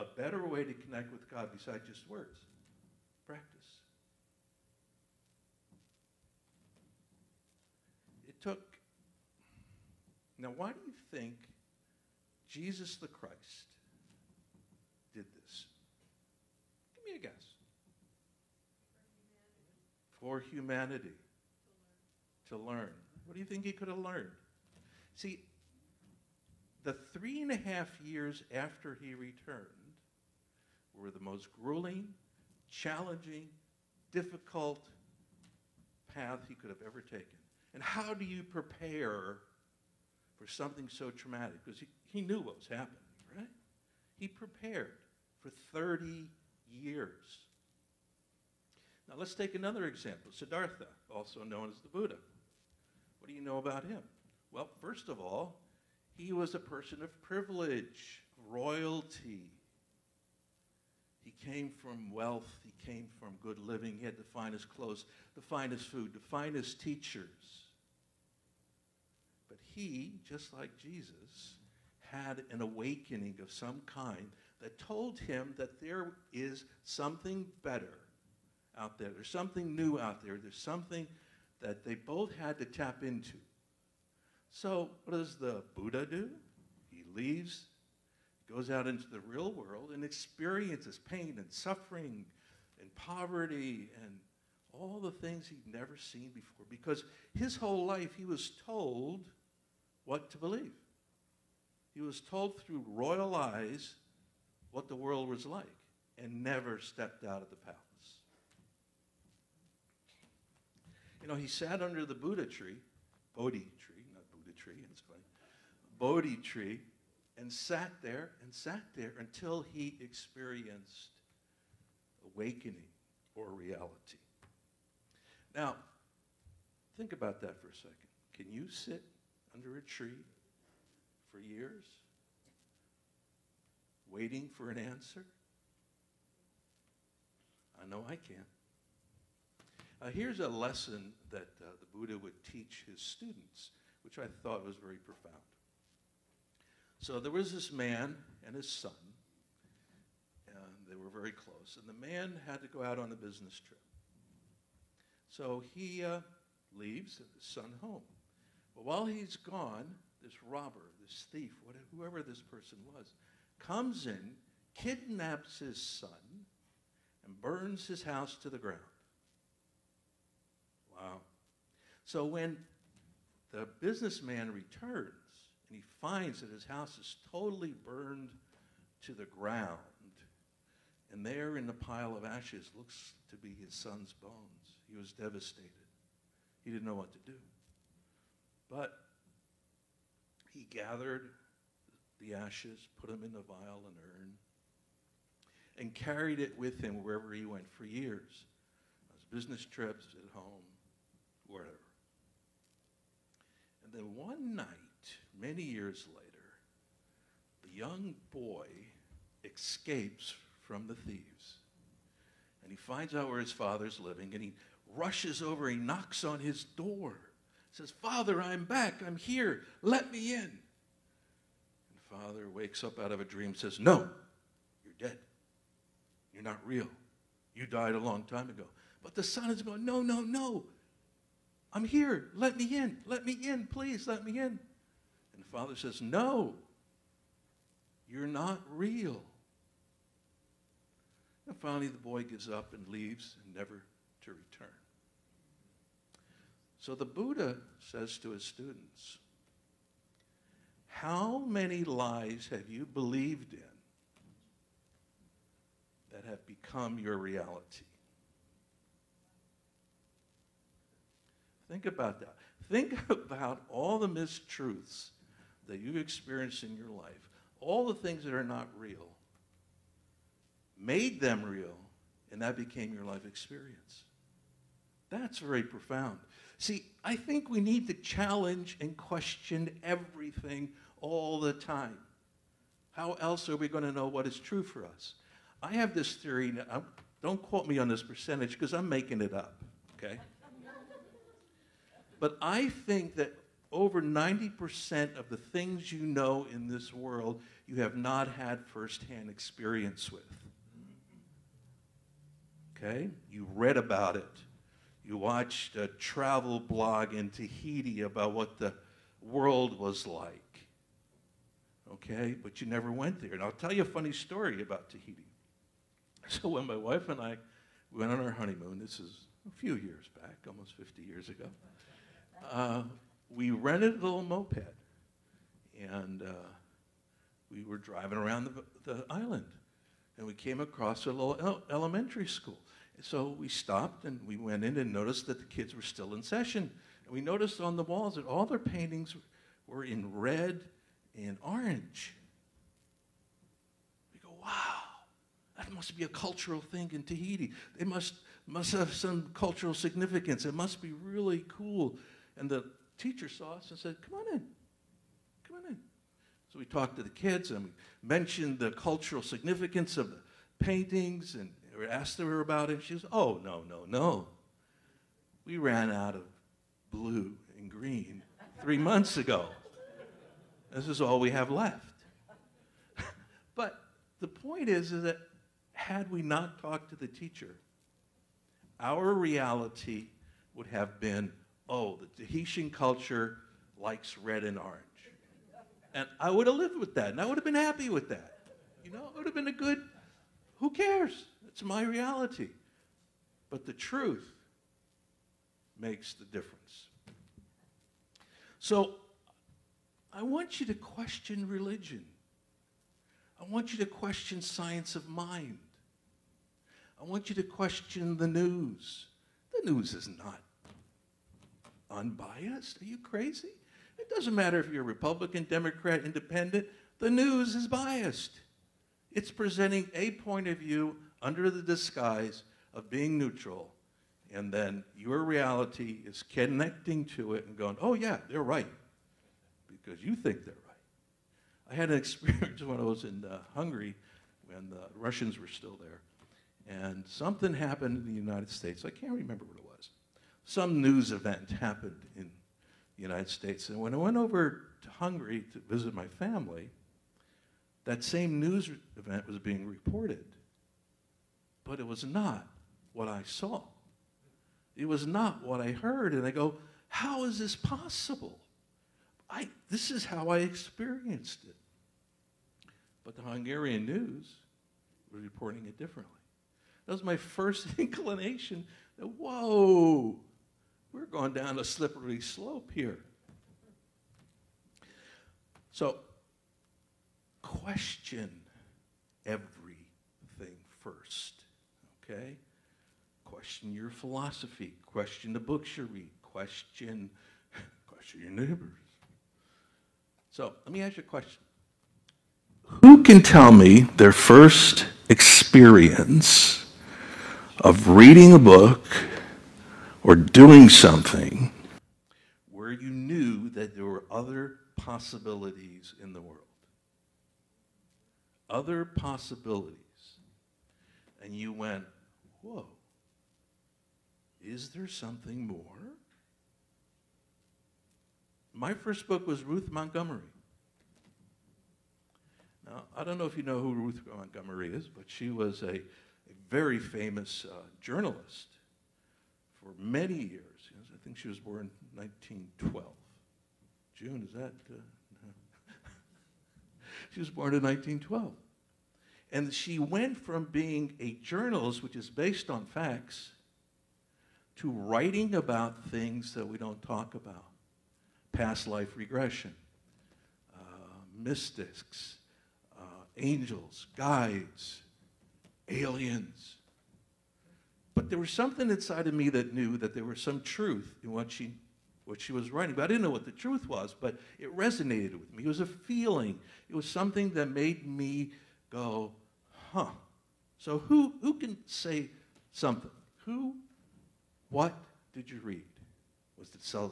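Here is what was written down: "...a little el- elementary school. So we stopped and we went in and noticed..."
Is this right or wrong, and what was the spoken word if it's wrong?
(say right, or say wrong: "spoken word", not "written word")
right.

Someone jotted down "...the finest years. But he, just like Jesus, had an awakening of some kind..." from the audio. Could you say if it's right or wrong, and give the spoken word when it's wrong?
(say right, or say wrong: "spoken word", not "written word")
wrong: "teachers", not "years".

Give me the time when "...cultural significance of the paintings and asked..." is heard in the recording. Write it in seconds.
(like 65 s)
358 s.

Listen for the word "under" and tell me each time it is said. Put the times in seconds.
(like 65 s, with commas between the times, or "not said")
111 s, 129 s, 421 s.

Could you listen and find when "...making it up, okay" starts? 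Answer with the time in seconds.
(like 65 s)
288 s.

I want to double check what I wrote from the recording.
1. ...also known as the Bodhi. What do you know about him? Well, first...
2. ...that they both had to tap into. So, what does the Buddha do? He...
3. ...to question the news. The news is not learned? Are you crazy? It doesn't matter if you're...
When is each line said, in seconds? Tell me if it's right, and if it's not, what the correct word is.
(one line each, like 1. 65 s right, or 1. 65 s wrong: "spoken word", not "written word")
1. 51 s wrong: "Buddha", not "Bodhi"
2. 81 s right
3. 407 s wrong: "unbiased", not "learned".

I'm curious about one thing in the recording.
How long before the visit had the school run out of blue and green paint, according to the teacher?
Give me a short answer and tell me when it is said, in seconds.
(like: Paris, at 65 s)
three months, at 368 s.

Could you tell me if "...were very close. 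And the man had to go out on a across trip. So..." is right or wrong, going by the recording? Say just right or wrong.
wrong.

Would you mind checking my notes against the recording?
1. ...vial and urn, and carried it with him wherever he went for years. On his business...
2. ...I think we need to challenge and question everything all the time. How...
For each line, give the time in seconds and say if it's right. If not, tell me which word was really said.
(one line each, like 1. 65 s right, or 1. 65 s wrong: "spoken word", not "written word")
1. 193 s right
2. 277 s right.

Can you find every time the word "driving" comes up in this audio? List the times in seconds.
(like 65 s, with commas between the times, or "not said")
327 s.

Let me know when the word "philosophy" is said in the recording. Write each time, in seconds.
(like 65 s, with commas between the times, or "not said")
483 s.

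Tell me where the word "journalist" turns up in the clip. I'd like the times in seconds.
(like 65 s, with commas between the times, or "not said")
527 s, 541 s.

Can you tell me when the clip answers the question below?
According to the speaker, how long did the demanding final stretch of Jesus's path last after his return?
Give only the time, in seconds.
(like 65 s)
27 s.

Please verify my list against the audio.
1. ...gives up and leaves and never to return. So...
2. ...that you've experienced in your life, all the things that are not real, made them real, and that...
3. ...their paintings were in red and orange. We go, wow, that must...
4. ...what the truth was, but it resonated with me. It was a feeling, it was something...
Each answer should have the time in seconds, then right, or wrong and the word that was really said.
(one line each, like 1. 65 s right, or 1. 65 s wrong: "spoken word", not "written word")
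1. 242 s right
2. 265 s right
3. 338 s right
4. 563 s right.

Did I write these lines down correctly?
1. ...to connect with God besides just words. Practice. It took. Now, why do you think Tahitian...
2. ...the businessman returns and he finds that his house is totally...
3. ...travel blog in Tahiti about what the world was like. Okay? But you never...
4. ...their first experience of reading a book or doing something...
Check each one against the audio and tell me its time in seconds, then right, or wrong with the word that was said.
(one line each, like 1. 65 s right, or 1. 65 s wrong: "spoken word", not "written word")
1. 0 s wrong: "Jesus", not "Tahitian"
2. 173 s right
3. 305 s right
4. 493 s right.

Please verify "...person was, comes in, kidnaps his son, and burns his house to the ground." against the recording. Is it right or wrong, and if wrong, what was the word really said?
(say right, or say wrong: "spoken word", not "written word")
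right.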